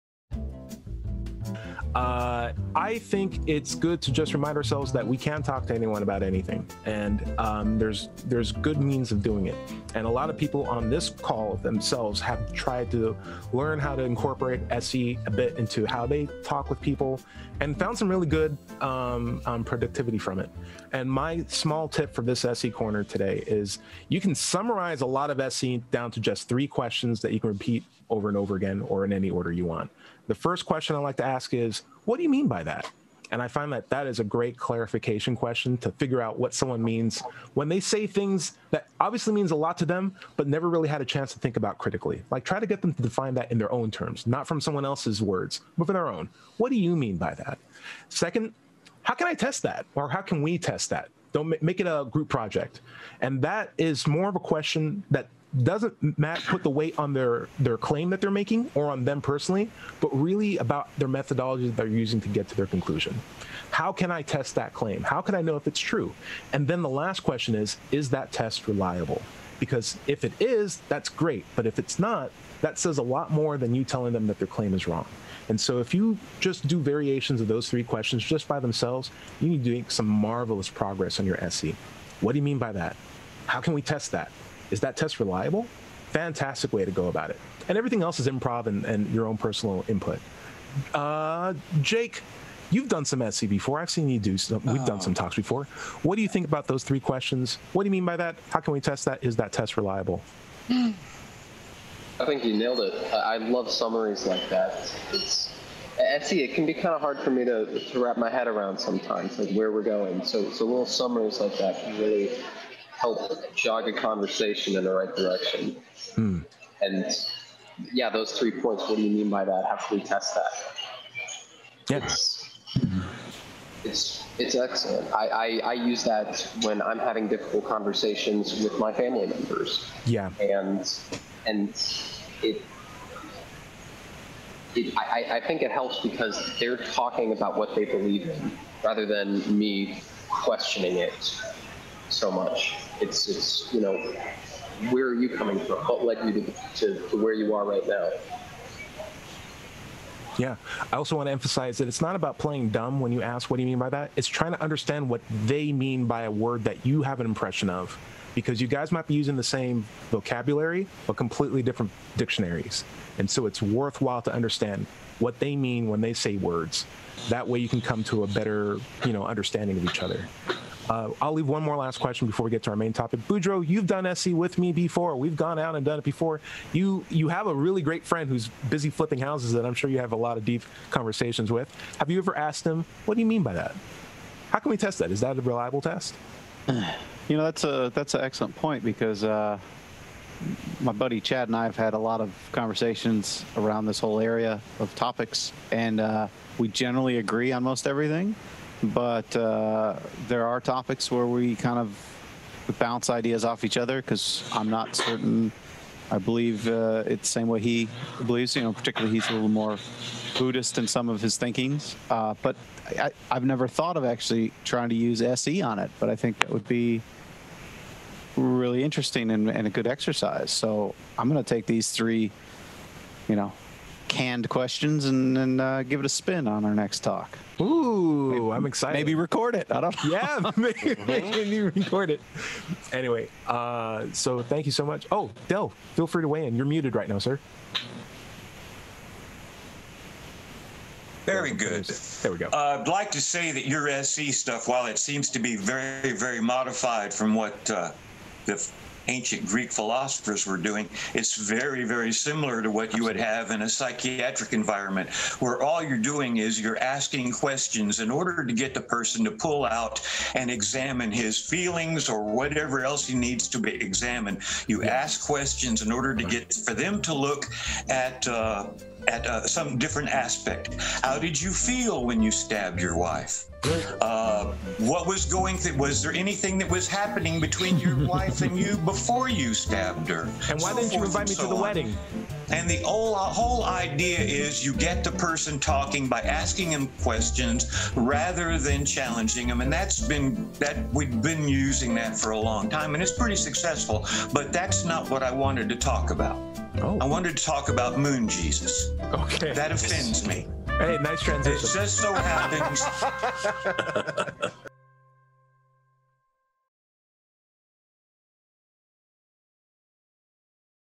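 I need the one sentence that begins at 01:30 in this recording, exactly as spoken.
Uh, Jake, you've done some SE before.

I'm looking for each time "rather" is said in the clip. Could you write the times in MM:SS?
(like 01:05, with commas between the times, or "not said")
02:18, 04:47.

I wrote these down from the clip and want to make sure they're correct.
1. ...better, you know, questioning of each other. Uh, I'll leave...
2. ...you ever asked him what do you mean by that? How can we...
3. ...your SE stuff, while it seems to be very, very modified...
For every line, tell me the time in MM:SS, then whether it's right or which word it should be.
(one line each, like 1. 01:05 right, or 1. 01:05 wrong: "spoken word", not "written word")
1. 02:48 wrong: "understanding", not "questioning"
2. 03:02 right
3. 04:03 right.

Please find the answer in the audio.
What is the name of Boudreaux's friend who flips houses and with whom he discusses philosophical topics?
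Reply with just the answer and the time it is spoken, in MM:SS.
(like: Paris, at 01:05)
Chad, at 03:11.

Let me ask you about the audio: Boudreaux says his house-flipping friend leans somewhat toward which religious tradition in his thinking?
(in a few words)
Buddhist.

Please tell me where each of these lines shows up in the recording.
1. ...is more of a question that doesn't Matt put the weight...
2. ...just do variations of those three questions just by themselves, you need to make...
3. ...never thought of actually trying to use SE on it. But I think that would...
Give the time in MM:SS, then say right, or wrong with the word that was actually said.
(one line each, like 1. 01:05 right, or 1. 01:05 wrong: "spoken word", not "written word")
1. 00:53 right
2. 01:16 right
3. 03:33 right.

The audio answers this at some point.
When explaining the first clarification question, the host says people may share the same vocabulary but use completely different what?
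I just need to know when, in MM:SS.
02:42.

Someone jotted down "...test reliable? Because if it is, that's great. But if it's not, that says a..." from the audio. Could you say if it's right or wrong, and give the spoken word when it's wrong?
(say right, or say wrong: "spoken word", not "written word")
right.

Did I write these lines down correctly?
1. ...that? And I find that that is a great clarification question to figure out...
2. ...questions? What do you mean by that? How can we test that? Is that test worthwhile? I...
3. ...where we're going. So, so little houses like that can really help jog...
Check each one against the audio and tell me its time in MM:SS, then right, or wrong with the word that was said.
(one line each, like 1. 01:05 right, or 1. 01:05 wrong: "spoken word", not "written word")
1. 00:32 right
2. 01:36 wrong: "reliable", not "worthwhile"
3. 01:49 wrong: "summaries", not "houses".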